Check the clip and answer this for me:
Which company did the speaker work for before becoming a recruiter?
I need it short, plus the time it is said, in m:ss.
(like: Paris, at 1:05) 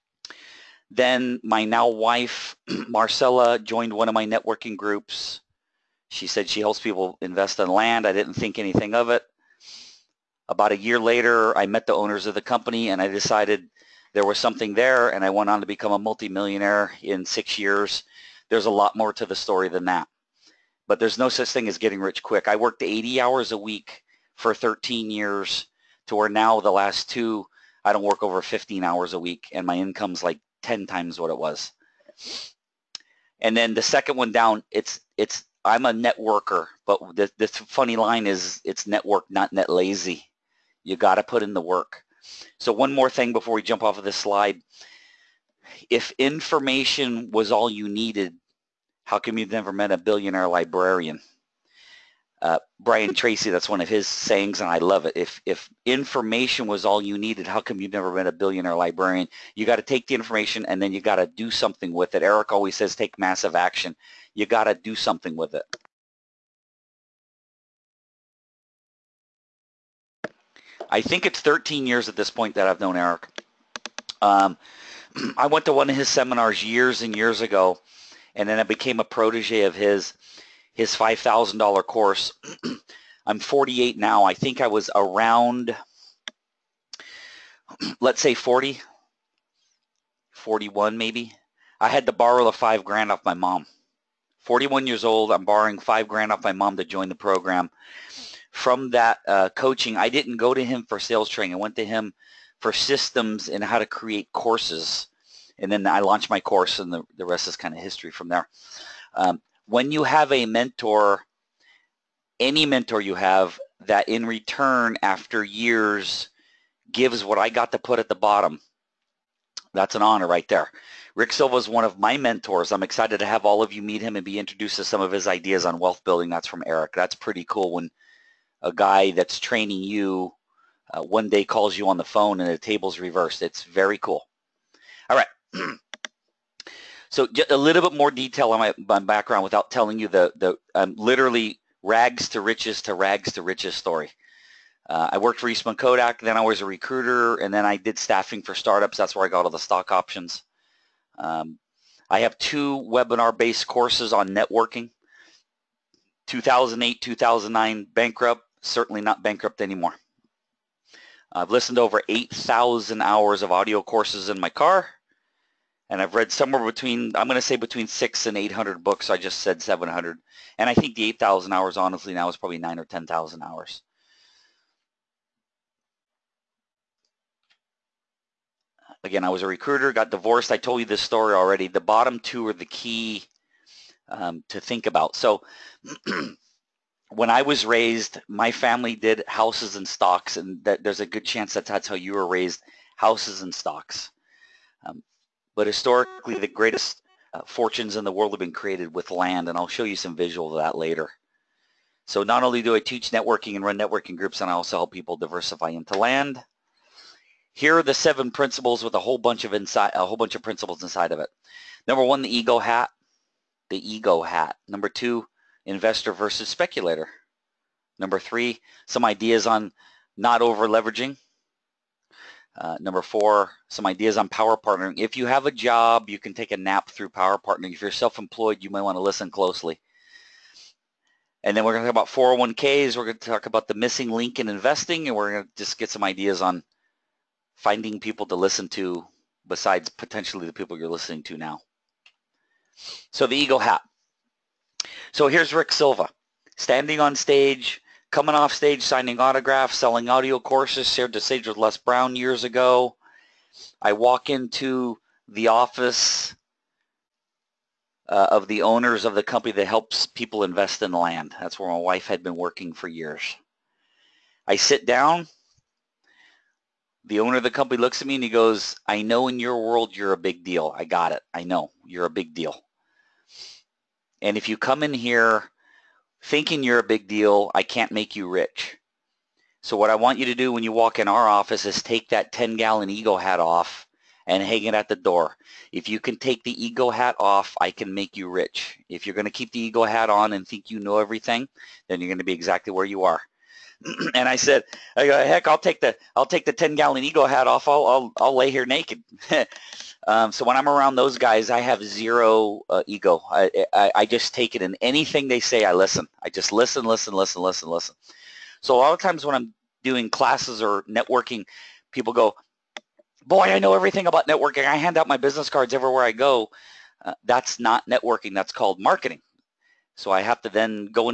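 Eastman Kodak, at 2:25.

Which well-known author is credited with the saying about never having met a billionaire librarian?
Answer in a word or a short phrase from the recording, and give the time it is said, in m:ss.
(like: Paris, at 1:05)
Brian Tracy, at 0:52.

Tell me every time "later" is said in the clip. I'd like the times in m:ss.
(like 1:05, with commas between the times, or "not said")
0:10, 3:20.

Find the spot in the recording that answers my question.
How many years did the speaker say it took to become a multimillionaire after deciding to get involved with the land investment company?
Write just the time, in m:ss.
0:17.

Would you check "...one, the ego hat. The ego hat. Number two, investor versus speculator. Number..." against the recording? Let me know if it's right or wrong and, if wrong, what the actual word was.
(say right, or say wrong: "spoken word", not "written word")
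right.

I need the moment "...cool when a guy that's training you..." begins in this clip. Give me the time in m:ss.
2:07.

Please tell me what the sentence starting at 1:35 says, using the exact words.
I'm borrowing five grand off my mom to join the program.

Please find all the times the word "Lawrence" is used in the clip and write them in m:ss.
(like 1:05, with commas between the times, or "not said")
not said.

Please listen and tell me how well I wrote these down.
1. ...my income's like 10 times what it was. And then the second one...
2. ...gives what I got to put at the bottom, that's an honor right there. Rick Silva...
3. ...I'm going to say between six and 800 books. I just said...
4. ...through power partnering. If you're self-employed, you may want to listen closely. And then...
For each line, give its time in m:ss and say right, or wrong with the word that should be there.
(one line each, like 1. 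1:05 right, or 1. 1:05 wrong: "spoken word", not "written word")
1. 0:29 right
2. 1:56 right
3. 2:47 right
4. 3:46 right.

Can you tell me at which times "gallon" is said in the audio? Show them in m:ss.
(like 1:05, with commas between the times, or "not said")
4:42, 4:56.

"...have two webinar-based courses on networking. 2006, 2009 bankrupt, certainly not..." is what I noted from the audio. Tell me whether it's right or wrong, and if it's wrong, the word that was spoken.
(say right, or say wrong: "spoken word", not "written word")
wrong: "2008", not "2006".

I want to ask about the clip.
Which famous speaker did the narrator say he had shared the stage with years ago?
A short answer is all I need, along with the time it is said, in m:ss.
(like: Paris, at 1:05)
Les Brown, at 4:11.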